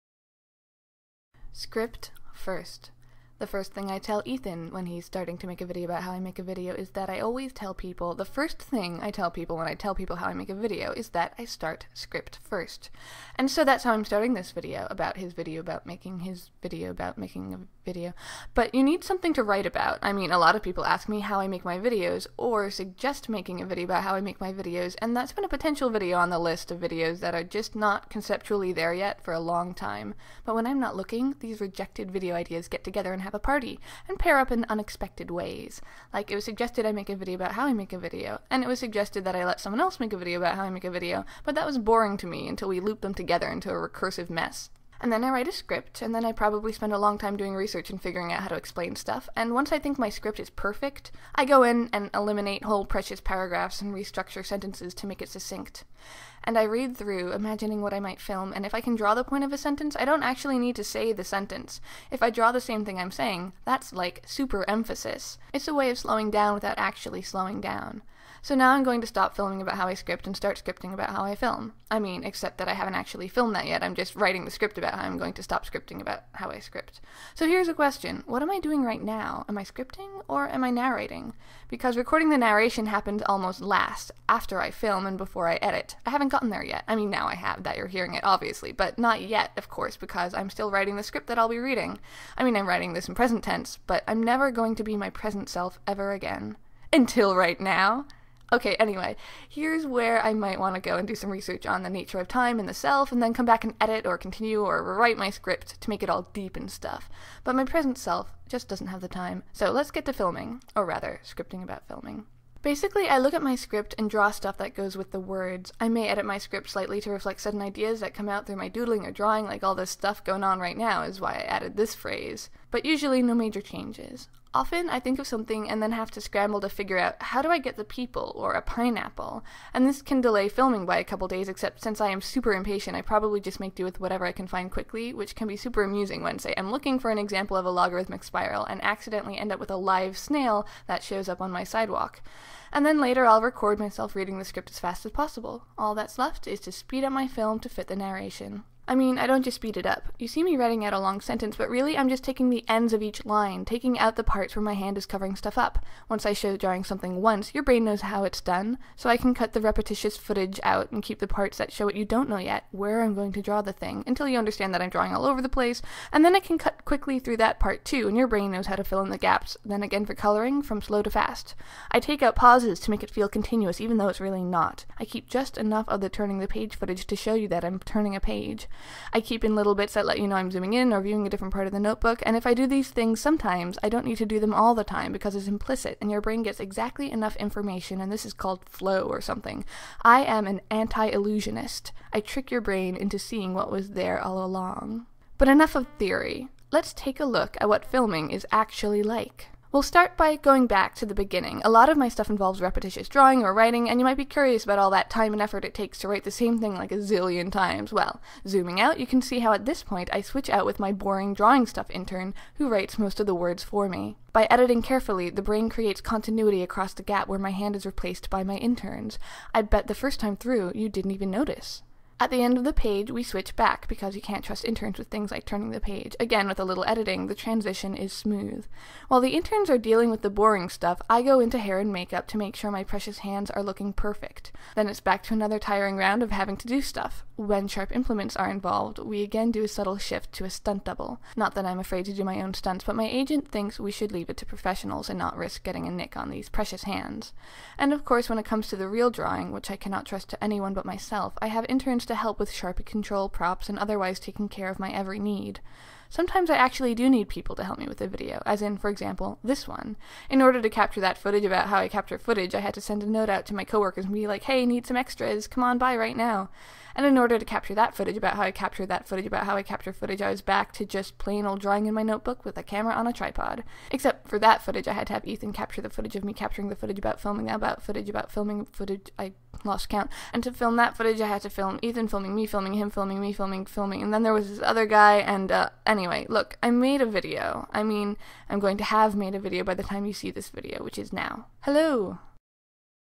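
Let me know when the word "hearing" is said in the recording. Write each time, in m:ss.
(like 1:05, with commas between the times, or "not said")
1:27.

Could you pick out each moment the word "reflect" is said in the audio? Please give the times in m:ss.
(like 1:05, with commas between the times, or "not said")
1:57.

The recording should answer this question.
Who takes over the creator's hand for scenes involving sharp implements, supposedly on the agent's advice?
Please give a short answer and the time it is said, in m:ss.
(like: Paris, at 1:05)
a stunt double, at 4:00.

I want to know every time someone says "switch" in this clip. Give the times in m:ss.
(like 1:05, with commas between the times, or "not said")
3:30, 3:43.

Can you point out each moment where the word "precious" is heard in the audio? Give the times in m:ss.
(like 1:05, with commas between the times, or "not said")
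0:52, 3:52, 4:06.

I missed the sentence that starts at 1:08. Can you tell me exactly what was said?
So now I'm going to stop filming about how I script and start scripting about how I film.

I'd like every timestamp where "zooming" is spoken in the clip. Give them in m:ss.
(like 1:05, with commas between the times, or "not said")
3:00, 3:28.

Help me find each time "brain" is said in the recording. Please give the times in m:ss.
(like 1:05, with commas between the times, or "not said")
2:37, 2:48, 3:06, 3:12, 3:35.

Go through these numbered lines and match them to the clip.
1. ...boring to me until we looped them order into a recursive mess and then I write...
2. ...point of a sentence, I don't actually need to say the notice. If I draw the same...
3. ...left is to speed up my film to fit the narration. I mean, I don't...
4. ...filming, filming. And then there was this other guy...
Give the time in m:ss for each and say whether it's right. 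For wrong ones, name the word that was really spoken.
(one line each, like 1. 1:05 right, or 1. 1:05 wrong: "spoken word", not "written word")
1. 0:41 wrong: "together", not "order"
2. 0:59 wrong: "sentence", not "notice"
3. 2:26 right
4. 4:43 right.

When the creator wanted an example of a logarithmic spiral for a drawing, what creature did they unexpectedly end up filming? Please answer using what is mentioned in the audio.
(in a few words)
a live snail.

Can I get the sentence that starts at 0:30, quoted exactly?
But when I'm not looking, these rejected video ideas get together and have have a party and pair up in unexpected ways.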